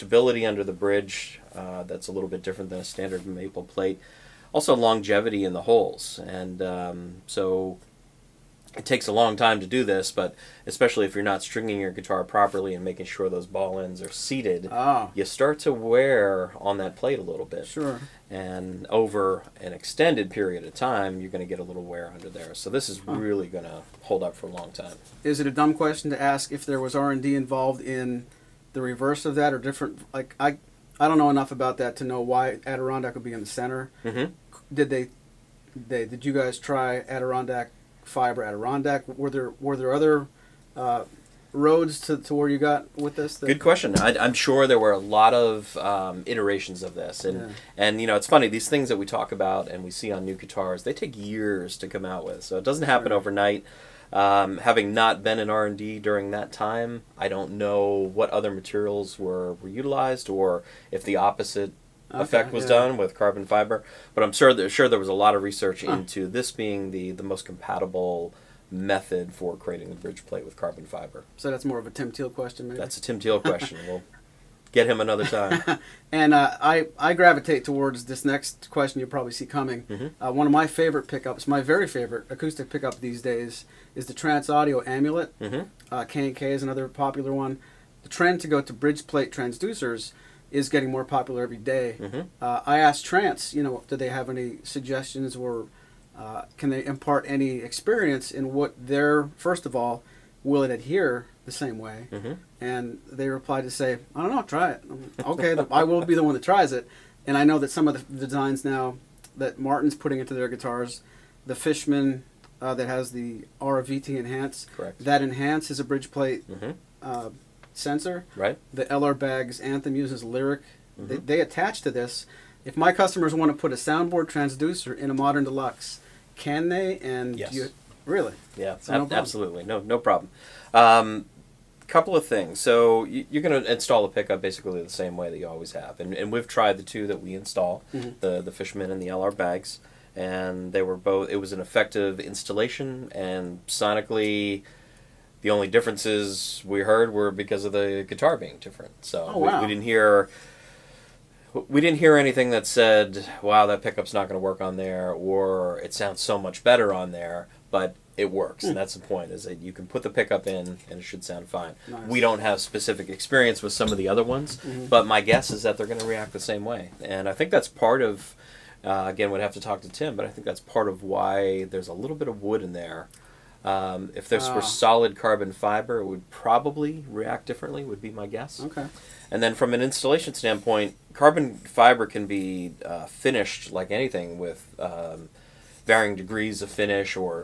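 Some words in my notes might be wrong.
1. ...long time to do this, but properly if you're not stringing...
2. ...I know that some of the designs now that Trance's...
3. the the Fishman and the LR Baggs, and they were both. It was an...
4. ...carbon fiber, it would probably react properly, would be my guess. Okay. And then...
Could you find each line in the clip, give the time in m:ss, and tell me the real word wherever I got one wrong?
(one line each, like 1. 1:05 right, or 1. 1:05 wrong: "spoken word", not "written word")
1. 0:09 wrong: "especially", not "properly"
2. 1:47 wrong: "Martin", not "Trance"
3. 2:18 right
4. 2:55 wrong: "differently", not "properly".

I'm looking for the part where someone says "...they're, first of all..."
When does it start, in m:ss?
1:38.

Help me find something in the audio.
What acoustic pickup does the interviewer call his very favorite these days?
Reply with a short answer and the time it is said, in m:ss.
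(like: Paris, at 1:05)
Trance Audio Amulet, at 1:24.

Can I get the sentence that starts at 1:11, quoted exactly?
So that's more of a Tim Teel question, maybe?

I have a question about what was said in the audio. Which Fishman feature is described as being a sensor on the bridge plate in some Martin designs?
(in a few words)
RVT enhance.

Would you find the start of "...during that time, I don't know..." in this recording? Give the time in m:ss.
0:56.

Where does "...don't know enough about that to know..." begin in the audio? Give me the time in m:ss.
0:31.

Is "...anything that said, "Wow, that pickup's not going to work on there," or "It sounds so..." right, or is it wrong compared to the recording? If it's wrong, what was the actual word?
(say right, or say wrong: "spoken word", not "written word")
right.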